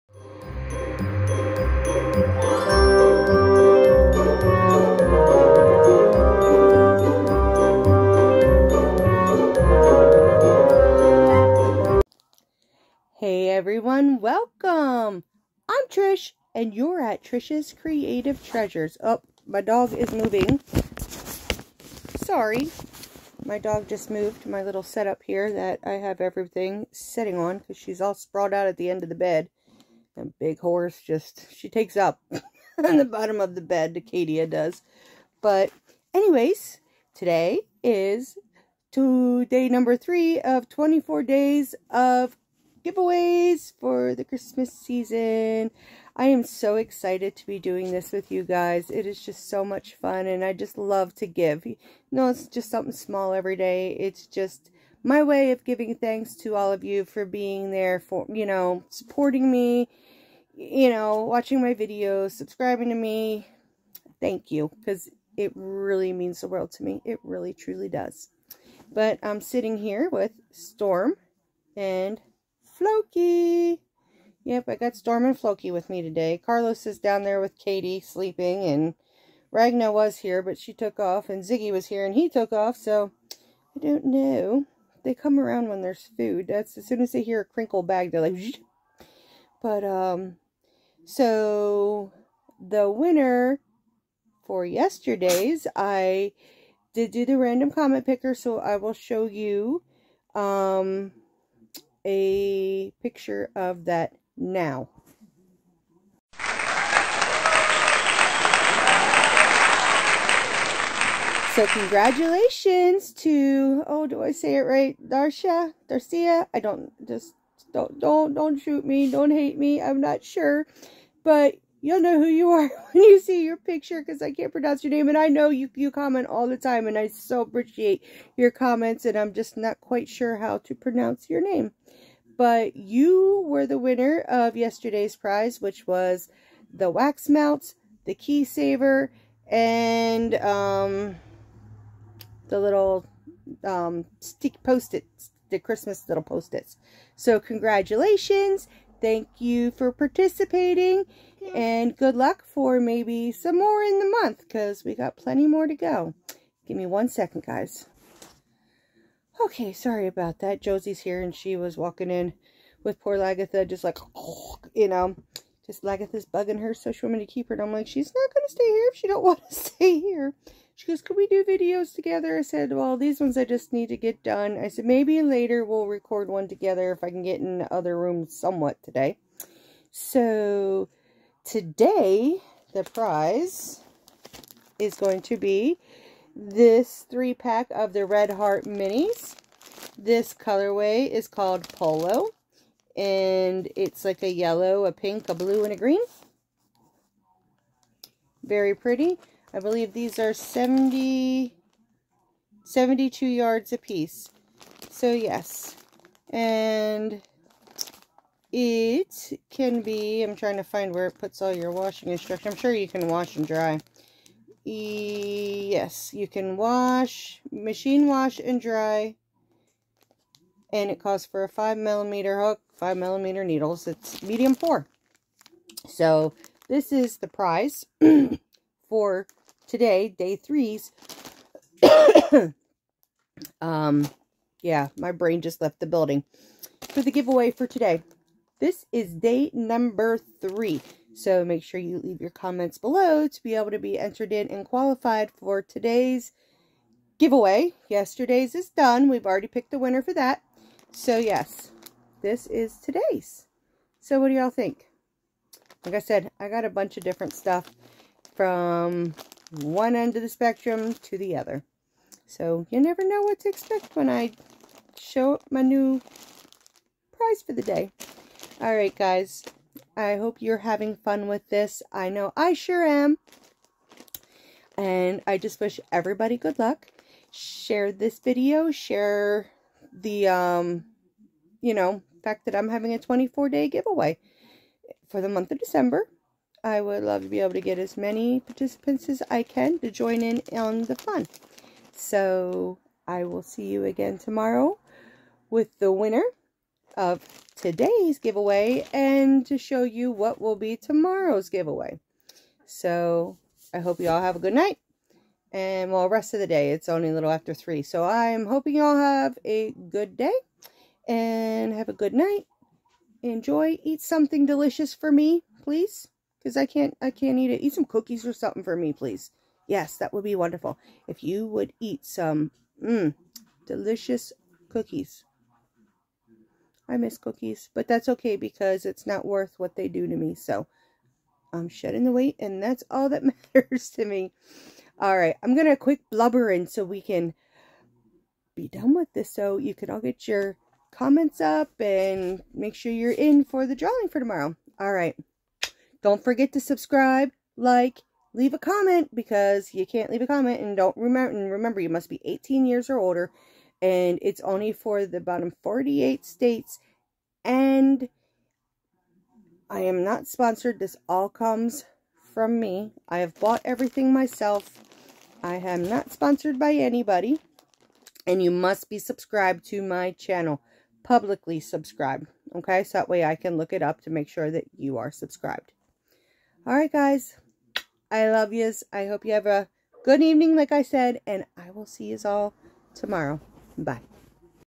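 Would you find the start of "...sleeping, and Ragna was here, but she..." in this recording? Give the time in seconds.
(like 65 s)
77 s.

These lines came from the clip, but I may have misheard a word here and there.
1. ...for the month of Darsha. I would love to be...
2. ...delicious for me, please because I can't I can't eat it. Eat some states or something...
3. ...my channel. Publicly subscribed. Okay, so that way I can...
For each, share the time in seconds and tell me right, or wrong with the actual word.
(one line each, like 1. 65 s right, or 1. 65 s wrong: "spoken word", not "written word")
1. 285 s wrong: "December", not "Darsha"
2. 314 s wrong: "cookies", not "states"
3. 369 s right.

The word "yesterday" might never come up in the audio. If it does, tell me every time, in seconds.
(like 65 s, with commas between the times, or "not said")
94 s, 134 s, 247 s.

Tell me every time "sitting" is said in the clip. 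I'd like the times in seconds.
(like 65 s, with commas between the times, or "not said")
26 s, 69 s.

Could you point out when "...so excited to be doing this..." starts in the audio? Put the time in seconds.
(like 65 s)
46 s.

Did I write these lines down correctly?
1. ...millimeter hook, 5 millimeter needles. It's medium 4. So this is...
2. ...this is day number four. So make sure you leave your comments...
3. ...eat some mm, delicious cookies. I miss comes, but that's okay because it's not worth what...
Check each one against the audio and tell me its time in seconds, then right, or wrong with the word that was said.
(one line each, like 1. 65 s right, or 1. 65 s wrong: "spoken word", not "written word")
1. 221 s right
2. 238 s wrong: "three", not "four"
3. 321 s wrong: "cookies", not "comes".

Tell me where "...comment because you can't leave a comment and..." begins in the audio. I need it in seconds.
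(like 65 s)
348 s.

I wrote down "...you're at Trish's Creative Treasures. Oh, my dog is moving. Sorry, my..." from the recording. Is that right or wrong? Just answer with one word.
right.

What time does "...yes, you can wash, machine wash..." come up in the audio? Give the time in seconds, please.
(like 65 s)
215 s.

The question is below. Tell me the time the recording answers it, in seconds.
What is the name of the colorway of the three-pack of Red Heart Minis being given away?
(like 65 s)
191 s.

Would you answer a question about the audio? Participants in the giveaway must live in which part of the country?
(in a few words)
Bottom 48 states.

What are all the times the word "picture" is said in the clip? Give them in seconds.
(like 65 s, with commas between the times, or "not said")
103 s, 123 s.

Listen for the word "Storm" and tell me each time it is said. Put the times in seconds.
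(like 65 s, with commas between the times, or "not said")
70 s, 74 s.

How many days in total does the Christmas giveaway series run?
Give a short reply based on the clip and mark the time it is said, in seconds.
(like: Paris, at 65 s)
24, at 40 s.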